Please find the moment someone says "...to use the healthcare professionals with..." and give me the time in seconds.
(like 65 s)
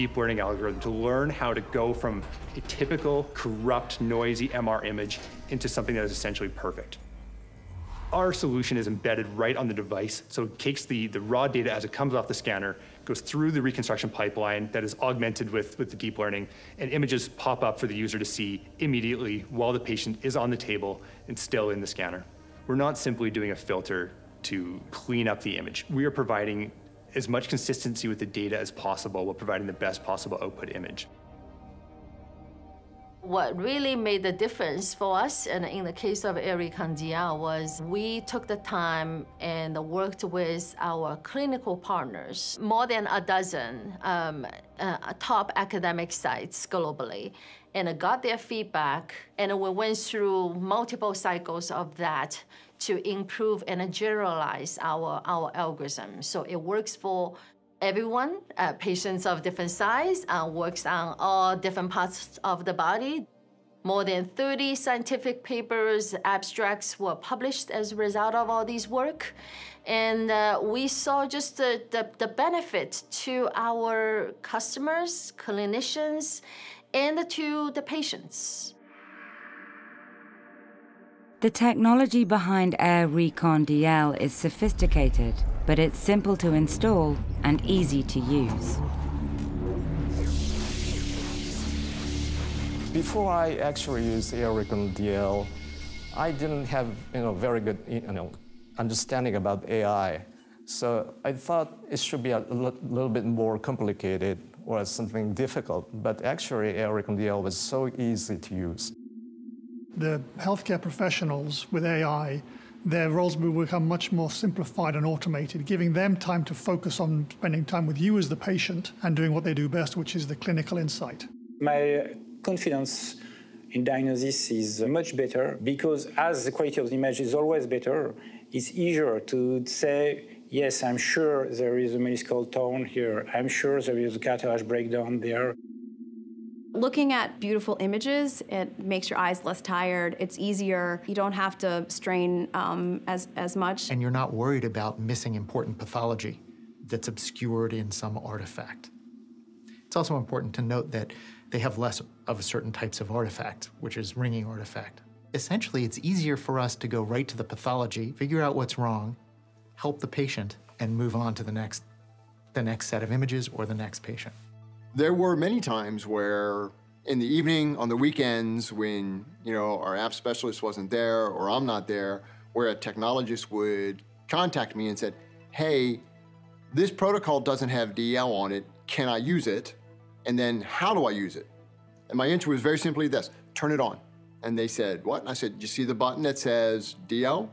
108 s.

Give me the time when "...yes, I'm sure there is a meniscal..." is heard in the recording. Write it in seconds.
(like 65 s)
130 s.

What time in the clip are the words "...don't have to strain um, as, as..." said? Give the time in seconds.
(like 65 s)
141 s.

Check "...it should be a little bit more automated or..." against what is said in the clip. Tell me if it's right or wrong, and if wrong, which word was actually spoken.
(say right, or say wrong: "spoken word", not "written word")
wrong: "complicated", not "automated".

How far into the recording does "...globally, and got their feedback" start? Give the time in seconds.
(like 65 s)
46 s.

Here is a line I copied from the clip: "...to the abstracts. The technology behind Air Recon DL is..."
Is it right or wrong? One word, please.
wrong.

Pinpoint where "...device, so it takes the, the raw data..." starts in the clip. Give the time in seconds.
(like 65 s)
9 s.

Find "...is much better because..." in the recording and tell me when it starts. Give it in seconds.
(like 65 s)
124 s.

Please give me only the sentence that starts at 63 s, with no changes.
More than 30 scientific papers, abstracts were published as a result of all these work.